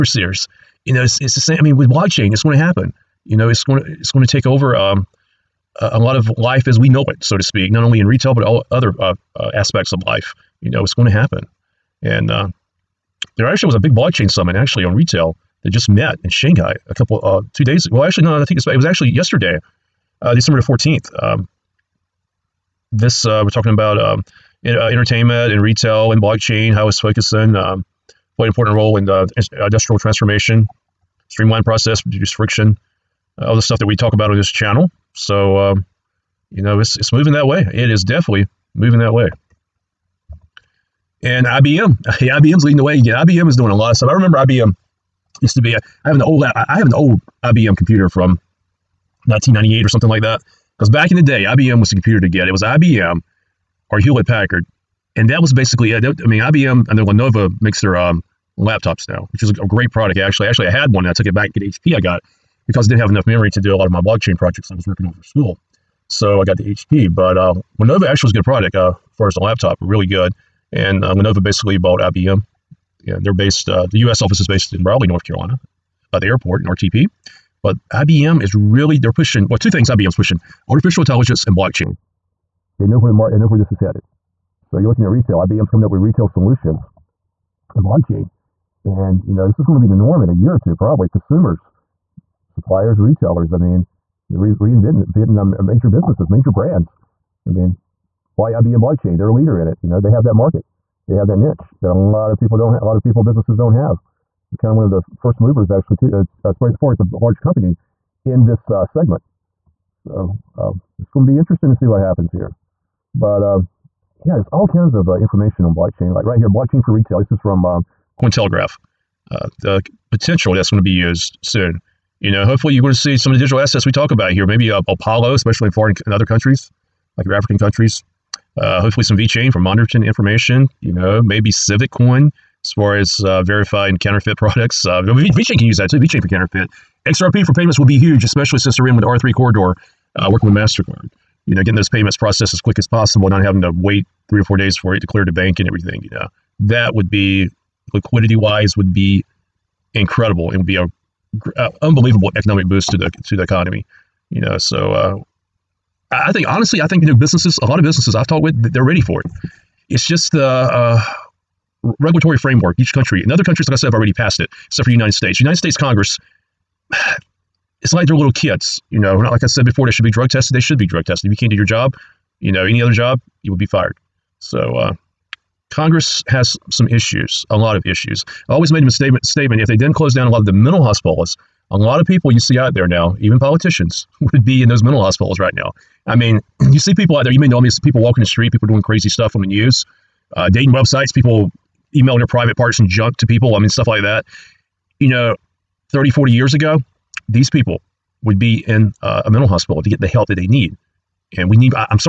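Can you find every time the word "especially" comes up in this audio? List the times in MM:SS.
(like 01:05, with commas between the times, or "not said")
02:05, 02:18.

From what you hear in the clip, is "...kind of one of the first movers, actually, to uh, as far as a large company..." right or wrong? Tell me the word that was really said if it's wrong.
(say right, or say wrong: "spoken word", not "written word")
right.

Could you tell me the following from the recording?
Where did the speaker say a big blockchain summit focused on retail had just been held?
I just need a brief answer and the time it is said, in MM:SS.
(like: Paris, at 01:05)
Shanghai, at 00:16.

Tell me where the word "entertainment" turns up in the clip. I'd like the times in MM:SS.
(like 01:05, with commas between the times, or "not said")
00:24.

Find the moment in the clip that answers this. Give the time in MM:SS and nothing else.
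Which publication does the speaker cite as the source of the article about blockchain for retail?
01:58.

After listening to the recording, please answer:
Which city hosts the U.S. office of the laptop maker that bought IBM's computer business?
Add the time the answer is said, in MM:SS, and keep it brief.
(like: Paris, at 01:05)
Raleigh, North Carolina, at 01:14.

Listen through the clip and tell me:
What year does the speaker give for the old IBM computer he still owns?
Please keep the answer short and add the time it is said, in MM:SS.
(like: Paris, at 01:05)
1998, at 00:49.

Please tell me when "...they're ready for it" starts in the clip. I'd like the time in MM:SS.
02:38.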